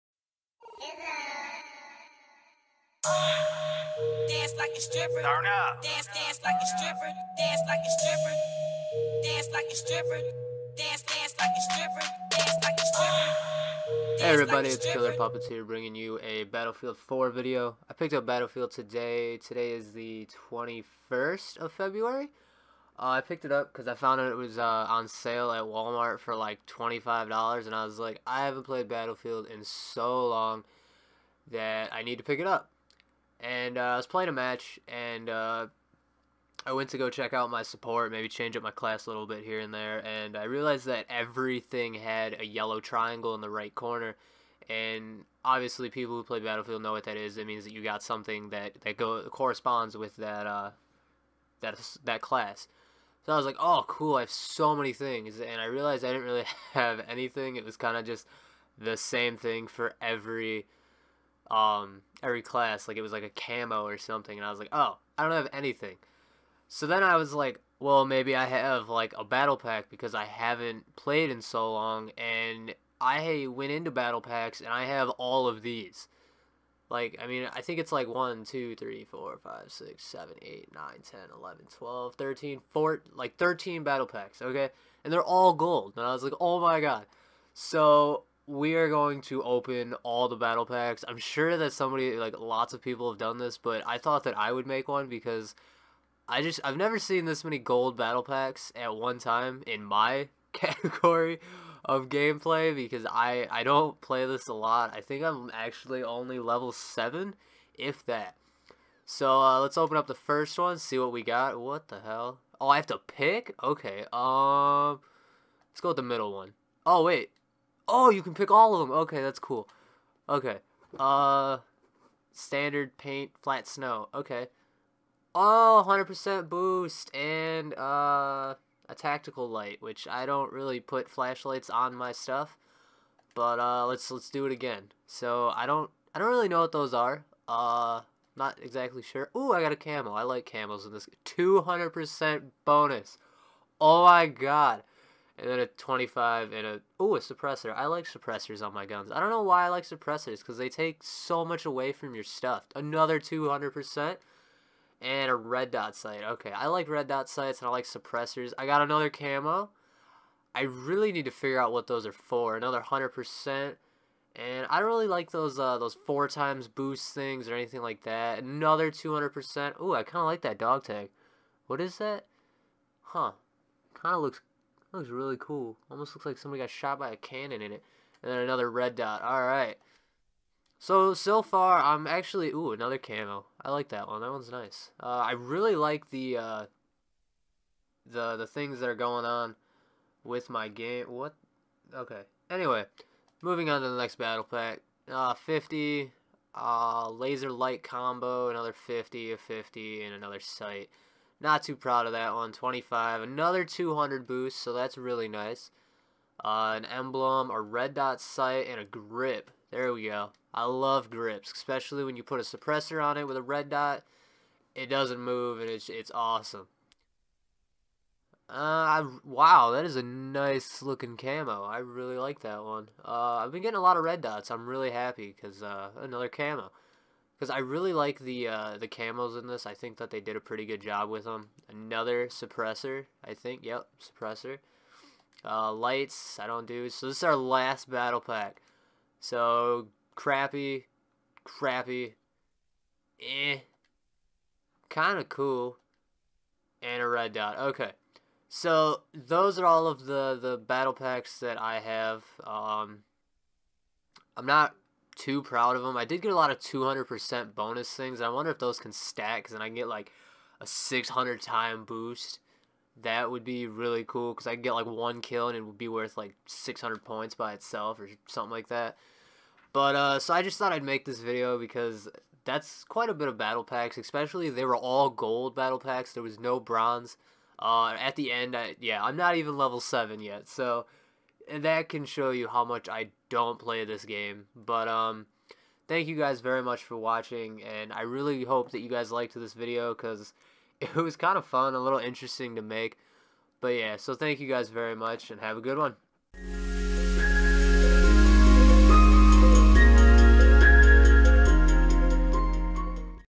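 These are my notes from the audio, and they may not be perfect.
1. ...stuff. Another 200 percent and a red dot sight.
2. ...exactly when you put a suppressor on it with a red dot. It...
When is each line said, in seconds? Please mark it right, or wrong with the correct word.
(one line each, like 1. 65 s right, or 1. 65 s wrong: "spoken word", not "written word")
1. 152 s right
2. 211 s wrong: "especially", not "exactly".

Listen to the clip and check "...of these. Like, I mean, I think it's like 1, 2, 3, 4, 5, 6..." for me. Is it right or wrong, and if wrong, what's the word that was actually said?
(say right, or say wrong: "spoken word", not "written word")
right.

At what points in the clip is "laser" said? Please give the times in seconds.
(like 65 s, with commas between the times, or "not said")
197 s.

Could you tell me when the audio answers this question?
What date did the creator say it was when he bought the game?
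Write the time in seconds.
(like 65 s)
20 s.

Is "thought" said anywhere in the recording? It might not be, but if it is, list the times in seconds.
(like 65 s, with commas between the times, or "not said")
93 s, 270 s.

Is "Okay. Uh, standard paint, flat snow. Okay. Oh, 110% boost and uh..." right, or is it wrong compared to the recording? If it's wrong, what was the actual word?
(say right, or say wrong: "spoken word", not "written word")
wrong: "100", not "110".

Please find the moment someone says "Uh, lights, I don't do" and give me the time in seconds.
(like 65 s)
235 s.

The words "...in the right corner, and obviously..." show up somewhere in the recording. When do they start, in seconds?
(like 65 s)
43 s.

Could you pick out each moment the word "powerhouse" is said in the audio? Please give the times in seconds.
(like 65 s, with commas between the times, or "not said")
not said.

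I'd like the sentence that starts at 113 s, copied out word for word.
Okay, um, let's go with the middle one.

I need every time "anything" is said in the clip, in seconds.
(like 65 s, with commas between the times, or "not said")
57 s, 65 s, 167 s.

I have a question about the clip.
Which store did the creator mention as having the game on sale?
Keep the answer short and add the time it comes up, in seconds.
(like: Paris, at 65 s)
Walmart, at 25 s.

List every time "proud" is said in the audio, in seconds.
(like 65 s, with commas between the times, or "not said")
201 s, 255 s.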